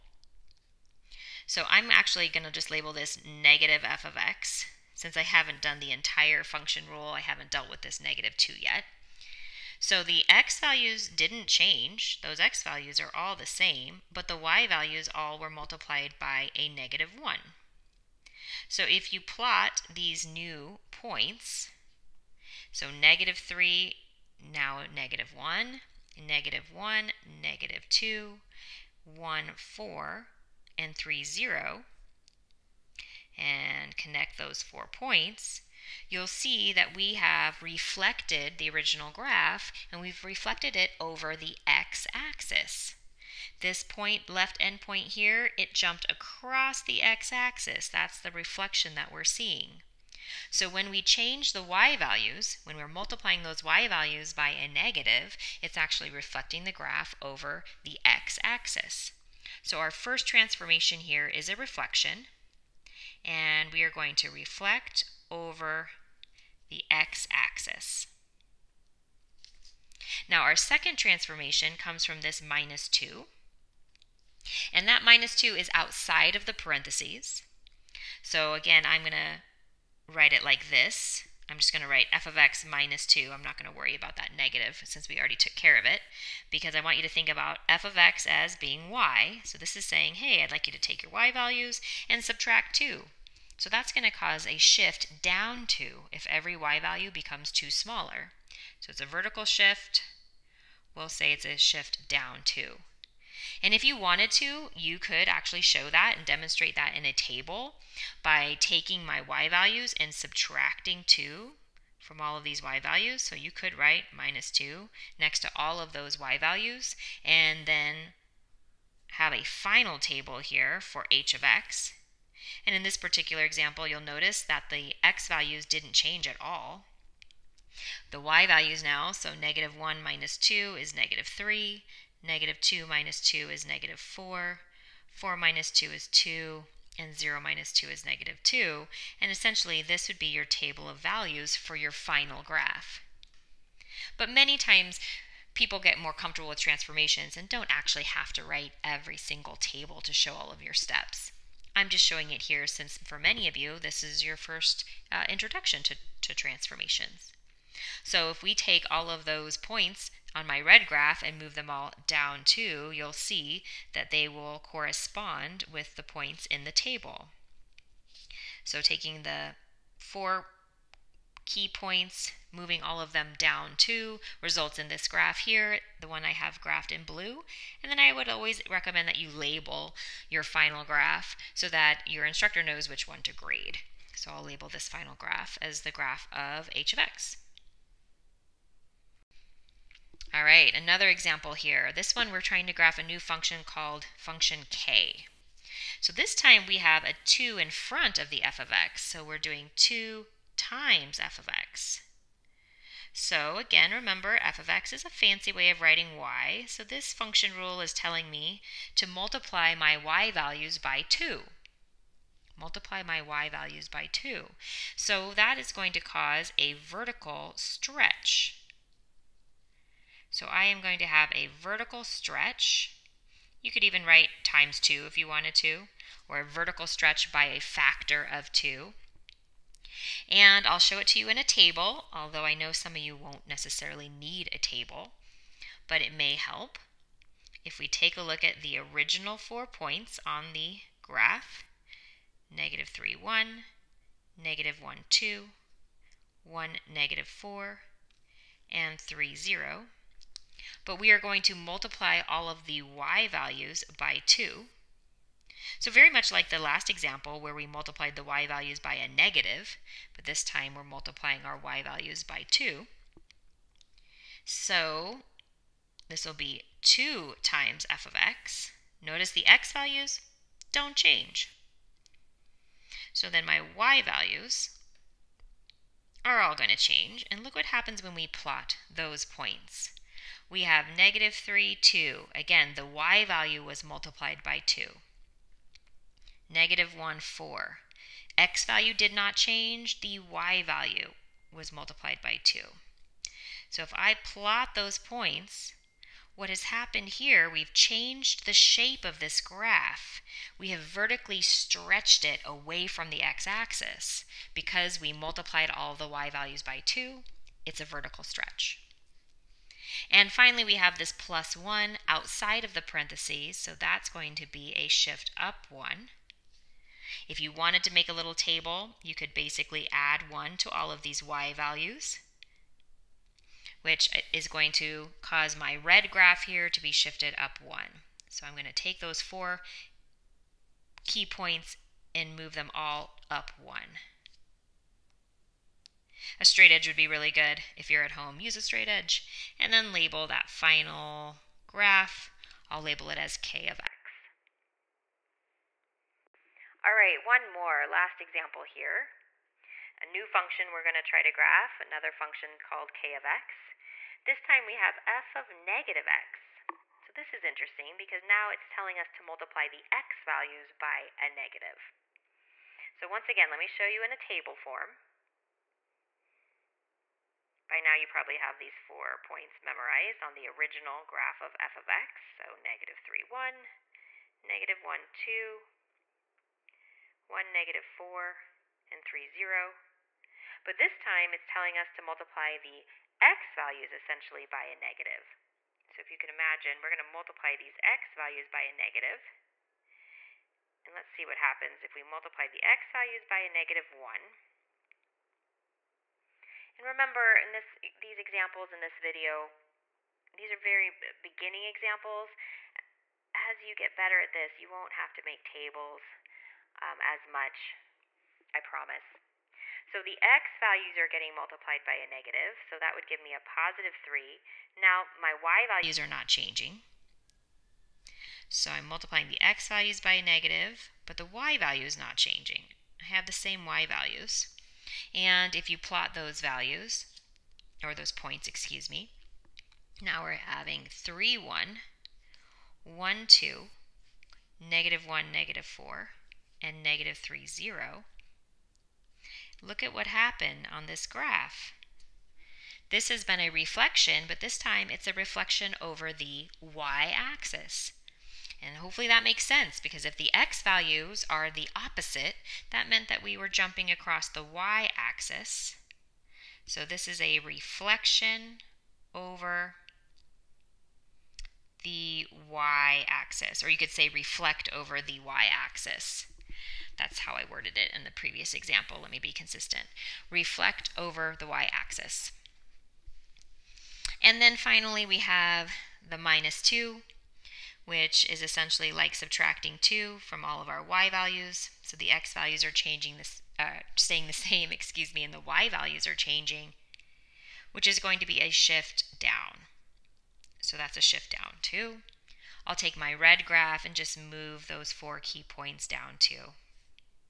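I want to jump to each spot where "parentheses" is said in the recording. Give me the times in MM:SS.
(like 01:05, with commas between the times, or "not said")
01:16, 05:12.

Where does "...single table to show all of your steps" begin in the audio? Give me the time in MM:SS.
02:29.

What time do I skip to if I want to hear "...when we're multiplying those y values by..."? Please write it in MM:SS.
00:52.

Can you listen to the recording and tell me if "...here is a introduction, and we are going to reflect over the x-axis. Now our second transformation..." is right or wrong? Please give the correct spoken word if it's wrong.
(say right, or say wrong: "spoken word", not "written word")
wrong: "reflection", not "introduction".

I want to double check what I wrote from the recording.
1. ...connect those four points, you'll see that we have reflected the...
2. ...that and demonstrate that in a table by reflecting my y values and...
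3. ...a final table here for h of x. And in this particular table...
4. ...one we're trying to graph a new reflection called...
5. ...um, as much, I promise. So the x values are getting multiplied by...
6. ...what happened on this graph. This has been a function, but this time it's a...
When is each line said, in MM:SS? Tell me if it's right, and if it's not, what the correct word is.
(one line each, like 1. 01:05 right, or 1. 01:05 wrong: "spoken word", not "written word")
1. 00:33 right
2. 01:45 wrong: "taking", not "reflecting"
3. 01:59 wrong: "example", not "table"
4. 03:12 wrong: "function", not "reflection"
5. 06:46 right
6. 07:19 wrong: "reflection", not "function".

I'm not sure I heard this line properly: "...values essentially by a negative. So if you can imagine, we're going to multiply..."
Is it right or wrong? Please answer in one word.
right.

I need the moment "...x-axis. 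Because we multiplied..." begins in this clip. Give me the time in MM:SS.
05:03.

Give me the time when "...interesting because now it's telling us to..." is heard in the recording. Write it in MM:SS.
05:57.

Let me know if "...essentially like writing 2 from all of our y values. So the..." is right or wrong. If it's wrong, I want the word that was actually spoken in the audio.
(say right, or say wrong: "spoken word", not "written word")
wrong: "subtracting", not "writing".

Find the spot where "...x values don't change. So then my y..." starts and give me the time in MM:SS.
04:29.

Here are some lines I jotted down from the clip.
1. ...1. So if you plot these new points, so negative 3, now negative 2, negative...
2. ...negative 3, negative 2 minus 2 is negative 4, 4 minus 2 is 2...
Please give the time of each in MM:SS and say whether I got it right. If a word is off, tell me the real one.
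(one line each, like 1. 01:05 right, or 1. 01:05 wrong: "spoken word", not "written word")
1. 00:17 wrong: "1", not "2"
2. 02:10 right.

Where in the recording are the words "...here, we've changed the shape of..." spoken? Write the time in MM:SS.
04:57.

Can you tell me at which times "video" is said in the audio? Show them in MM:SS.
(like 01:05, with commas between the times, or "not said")
06:38.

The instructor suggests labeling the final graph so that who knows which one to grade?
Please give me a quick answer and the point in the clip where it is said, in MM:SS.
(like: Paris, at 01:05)
Your instructor, at 03:02.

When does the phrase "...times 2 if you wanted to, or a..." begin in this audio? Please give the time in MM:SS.
03:44.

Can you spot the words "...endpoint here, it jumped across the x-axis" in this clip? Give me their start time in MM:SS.
00:44.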